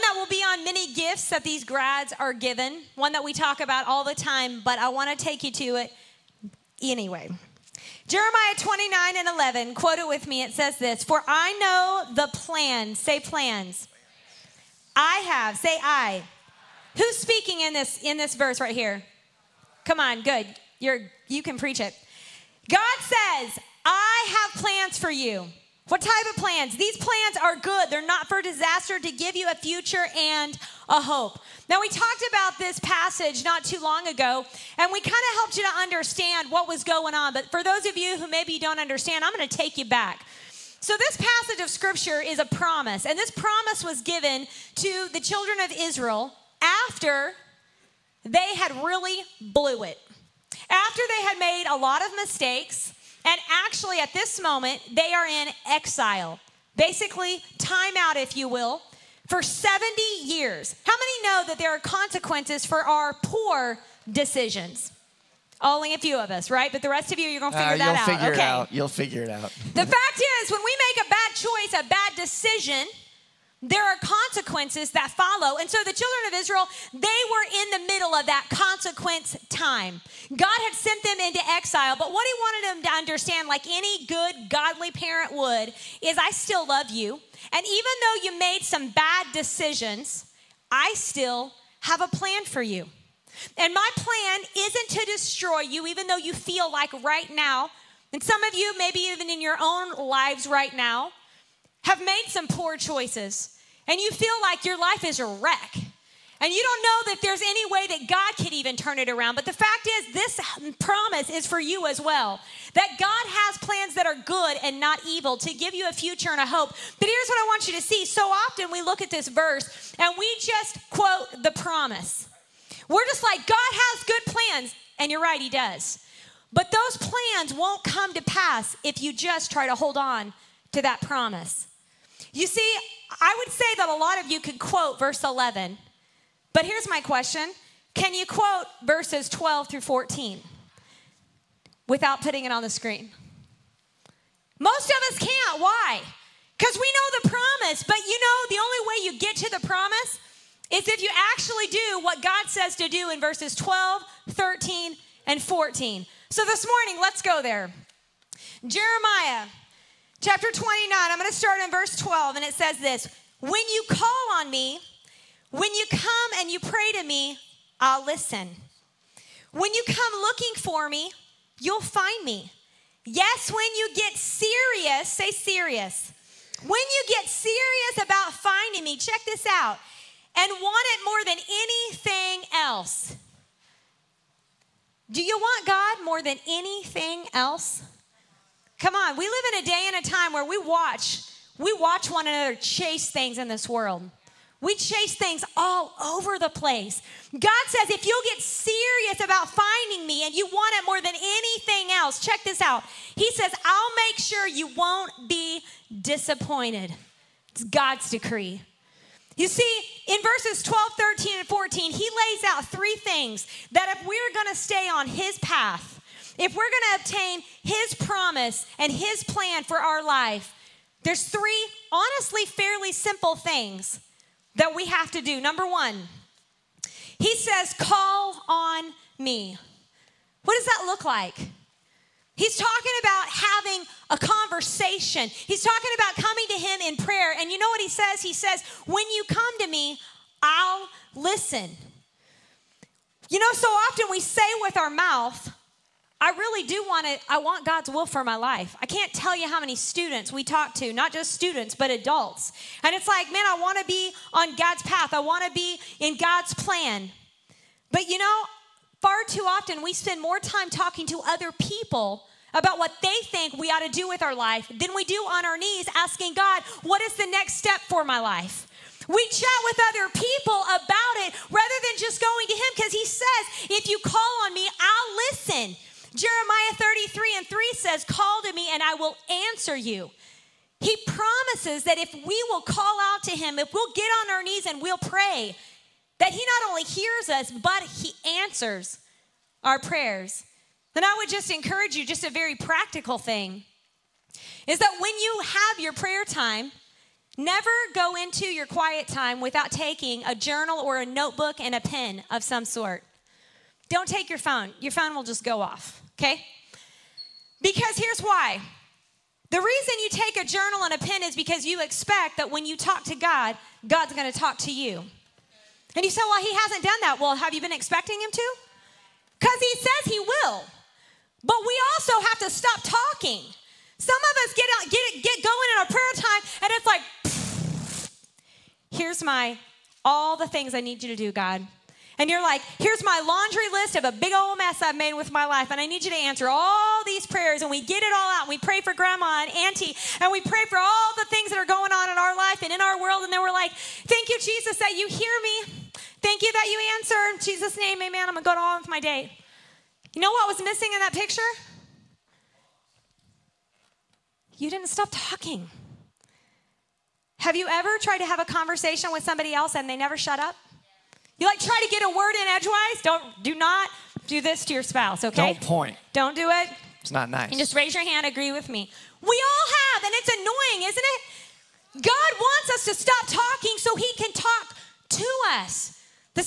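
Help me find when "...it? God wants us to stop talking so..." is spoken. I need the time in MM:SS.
06:11.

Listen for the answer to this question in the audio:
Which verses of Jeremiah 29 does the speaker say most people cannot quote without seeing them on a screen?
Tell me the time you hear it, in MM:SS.
02:19.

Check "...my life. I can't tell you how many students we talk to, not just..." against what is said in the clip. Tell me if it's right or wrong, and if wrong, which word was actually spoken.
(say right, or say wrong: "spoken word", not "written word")
right.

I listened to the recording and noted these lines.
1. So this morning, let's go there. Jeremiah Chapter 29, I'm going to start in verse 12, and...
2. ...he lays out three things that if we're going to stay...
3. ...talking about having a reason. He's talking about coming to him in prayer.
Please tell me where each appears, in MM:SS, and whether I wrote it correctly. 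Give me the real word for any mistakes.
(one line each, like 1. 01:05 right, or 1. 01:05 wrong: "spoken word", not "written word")
1. 02:36 right
2. 03:31 right
3. 03:52 wrong: "conversation", not "reason".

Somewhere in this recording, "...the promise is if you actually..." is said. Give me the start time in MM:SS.
02:29.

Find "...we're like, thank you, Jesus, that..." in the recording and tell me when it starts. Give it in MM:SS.
05:43.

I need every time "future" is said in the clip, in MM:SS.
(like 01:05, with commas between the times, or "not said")
00:29, 01:55.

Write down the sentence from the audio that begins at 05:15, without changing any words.
And you say, well, he hasn't done that.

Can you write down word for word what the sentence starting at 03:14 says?
We chase things all over the place.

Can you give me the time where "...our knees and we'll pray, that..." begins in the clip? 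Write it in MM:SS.
04:44.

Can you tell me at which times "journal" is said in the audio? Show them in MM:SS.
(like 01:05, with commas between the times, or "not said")
05:00, 05:10.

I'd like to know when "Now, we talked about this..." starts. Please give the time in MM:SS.
00:31.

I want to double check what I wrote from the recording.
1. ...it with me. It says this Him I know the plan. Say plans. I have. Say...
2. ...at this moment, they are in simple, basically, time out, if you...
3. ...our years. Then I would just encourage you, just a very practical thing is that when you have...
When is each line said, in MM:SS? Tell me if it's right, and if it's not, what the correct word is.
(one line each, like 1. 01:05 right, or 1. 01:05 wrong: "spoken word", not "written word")
1. 00:09 wrong: "For", not "Him"
2. 00:53 wrong: "exile", not "simple"
3. 04:49 wrong: "prayers", not "years".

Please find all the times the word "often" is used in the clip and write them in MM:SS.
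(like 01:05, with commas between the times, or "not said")
01:58, 04:03, 04:19.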